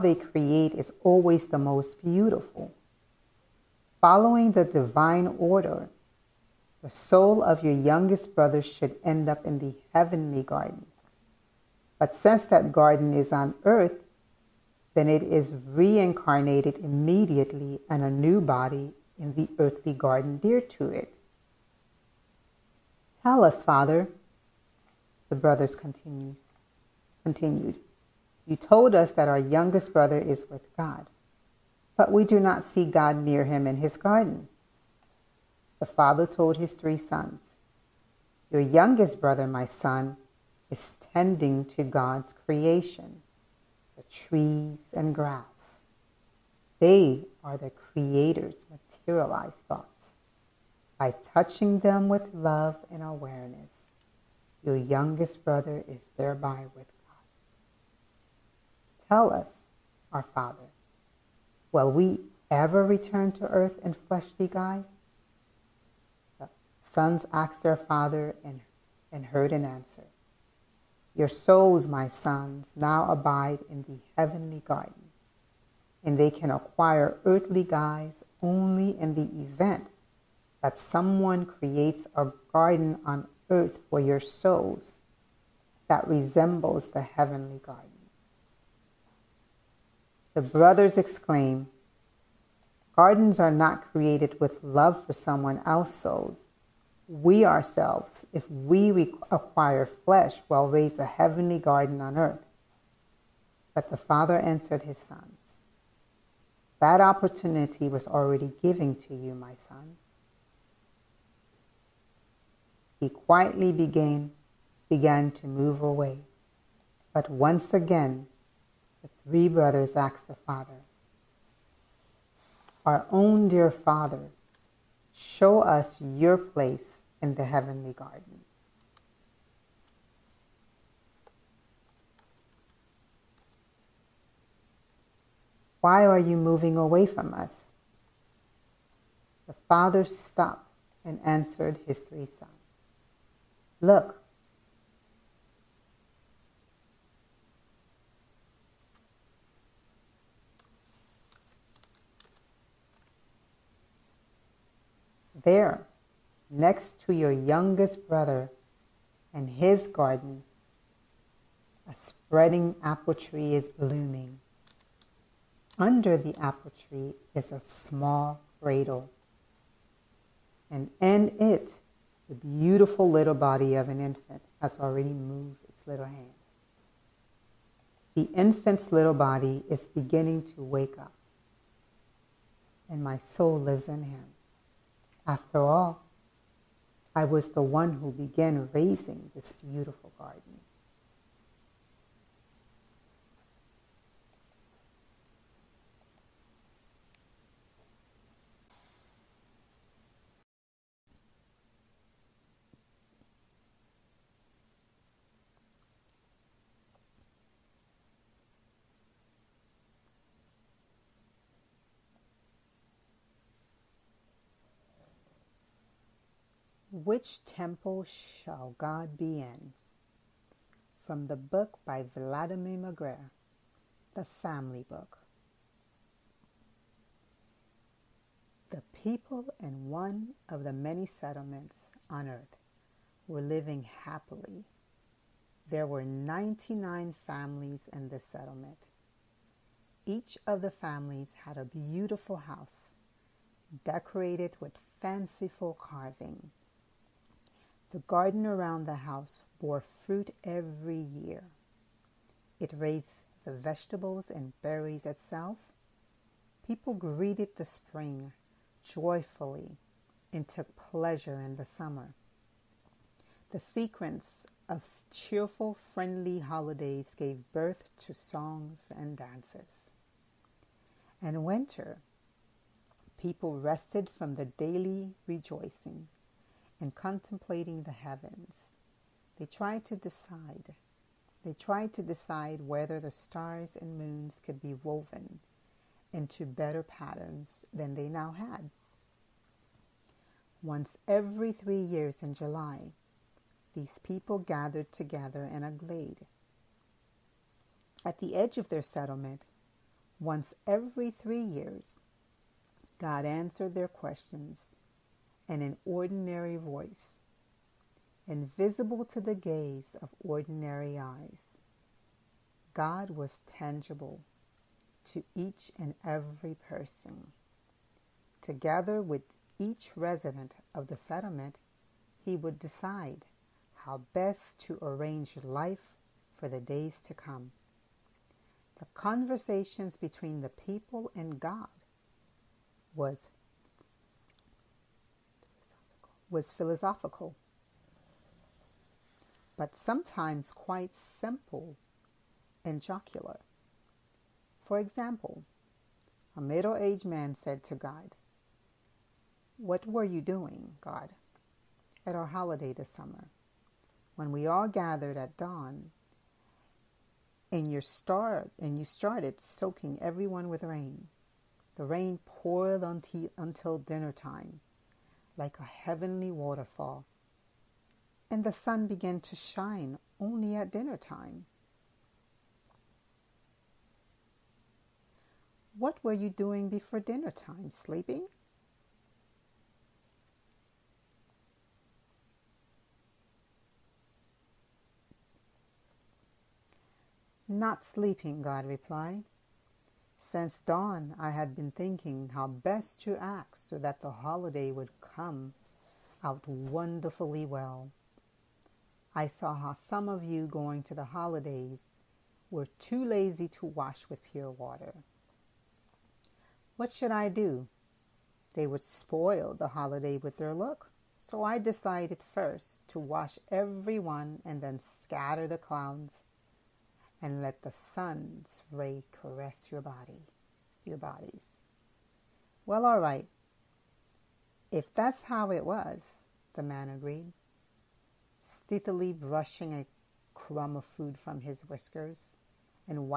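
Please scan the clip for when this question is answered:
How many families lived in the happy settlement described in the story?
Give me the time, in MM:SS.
03:56.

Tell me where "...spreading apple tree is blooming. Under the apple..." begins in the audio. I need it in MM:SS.
02:41.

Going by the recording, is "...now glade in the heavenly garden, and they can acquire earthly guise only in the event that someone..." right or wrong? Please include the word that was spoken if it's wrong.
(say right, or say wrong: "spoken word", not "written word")
wrong: "abide", not "glade".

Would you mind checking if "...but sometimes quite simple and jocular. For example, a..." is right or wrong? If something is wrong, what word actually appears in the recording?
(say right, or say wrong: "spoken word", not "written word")
right.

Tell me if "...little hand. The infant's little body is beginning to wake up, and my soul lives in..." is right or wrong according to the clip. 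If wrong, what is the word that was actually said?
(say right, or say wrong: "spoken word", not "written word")
right.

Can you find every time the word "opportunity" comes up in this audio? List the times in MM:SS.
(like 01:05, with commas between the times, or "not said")
01:47.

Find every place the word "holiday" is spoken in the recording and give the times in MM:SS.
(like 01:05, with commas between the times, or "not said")
04:26, 05:52, 06:34, 06:41, 06:49.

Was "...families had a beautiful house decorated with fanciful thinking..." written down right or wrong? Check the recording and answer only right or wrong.
wrong.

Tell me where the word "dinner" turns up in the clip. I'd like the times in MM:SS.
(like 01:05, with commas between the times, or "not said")
06:03, 06:10, 06:16.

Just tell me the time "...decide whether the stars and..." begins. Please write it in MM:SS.
04:42.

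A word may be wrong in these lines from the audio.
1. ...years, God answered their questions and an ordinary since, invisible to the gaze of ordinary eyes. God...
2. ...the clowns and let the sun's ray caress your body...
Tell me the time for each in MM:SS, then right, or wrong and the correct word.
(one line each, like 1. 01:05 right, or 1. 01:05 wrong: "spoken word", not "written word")
1. 05:01 wrong: "voice", not "since"
2. 06:55 right.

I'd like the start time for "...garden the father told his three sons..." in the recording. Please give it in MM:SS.
00:33.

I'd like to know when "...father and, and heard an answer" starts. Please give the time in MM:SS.
01:07.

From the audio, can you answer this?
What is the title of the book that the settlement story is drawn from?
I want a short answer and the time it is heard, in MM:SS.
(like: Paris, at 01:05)
The Family Book, at 03:44.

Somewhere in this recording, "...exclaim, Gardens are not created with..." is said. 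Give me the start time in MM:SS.
01:30.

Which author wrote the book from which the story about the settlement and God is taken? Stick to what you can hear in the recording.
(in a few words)
Vladimir Megre.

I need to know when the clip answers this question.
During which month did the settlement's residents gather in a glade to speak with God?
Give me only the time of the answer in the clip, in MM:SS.
04:52.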